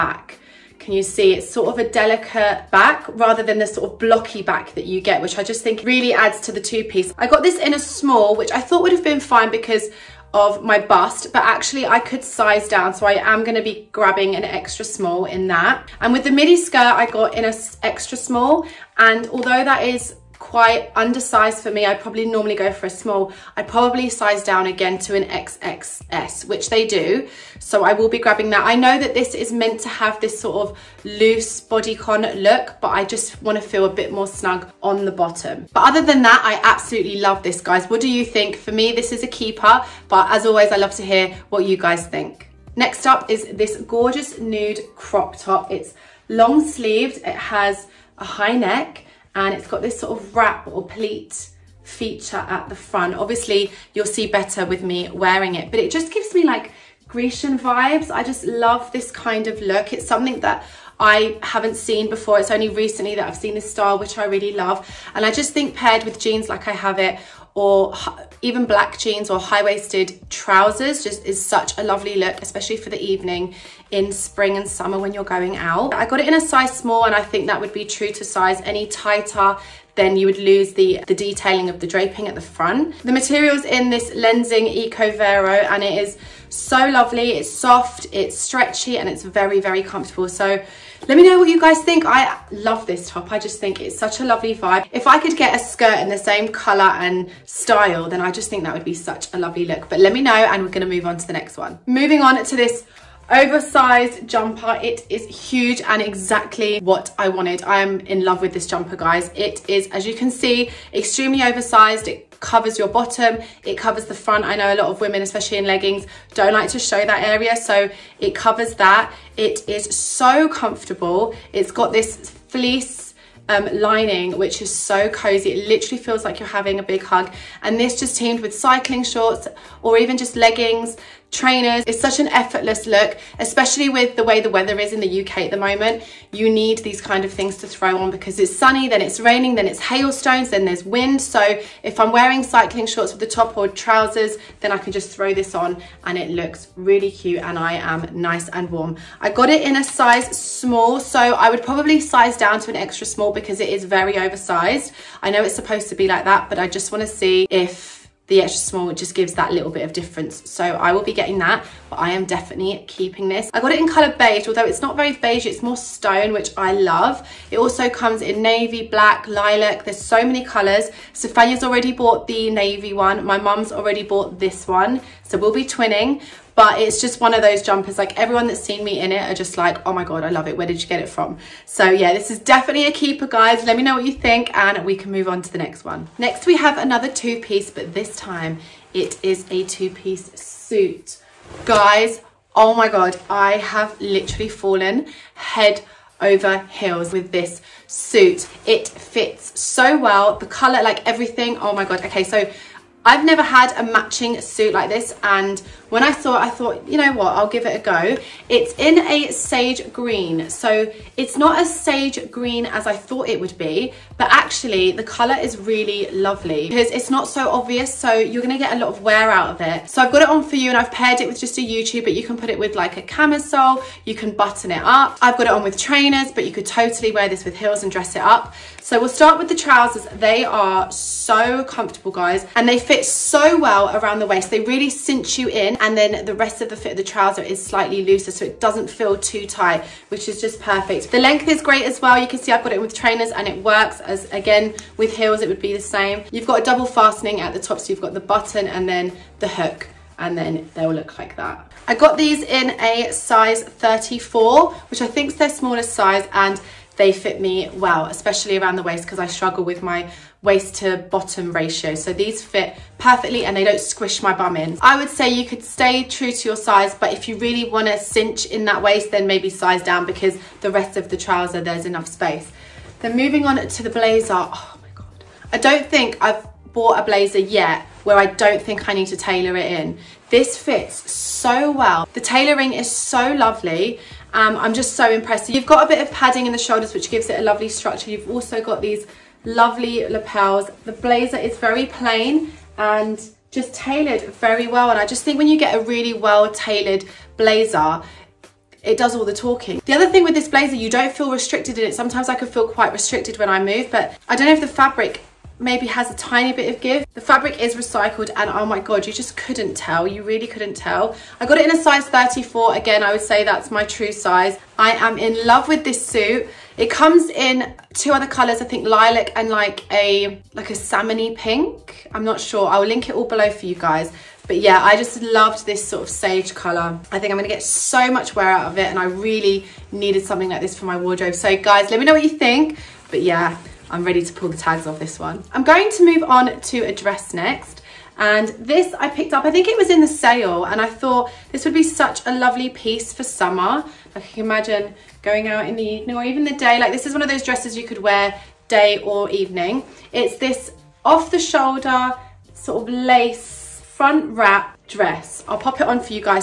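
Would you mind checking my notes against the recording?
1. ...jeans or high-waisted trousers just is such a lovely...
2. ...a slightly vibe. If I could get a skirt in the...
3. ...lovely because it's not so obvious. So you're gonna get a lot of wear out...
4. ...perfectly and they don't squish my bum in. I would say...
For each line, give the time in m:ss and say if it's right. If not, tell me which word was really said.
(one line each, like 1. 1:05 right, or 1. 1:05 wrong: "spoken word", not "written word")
1. 1:08 right
2. 1:34 wrong: "lovely", not "slightly"
3. 3:36 right
4. 4:22 right.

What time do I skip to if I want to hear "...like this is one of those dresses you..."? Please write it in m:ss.
5:46.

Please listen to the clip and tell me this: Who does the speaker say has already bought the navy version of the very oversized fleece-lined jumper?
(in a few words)
Stefania.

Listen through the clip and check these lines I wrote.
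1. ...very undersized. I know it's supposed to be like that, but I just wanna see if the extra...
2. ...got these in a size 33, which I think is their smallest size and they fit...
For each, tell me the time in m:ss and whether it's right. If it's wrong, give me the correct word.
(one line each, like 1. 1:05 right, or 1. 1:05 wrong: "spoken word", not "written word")
1. 2:33 wrong: "oversized", not "undersized"
2. 4:11 wrong: "34", not "33".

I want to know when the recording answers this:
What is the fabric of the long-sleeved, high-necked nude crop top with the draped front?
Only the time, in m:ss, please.
1:24.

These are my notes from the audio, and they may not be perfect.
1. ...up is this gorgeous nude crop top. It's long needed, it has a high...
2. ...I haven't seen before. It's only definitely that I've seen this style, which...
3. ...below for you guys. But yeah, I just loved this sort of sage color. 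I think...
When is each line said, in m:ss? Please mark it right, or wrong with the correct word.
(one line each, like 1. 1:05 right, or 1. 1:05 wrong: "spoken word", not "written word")
1. 0:43 wrong: "sleeved", not "needed"
2. 1:00 wrong: "recently", not "definitely"
3. 5:23 right.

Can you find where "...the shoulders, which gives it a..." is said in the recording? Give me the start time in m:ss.
4:46.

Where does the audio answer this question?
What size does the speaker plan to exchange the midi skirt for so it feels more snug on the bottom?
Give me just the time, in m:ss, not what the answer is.
0:25.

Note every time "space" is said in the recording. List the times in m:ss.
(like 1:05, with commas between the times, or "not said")
4:32.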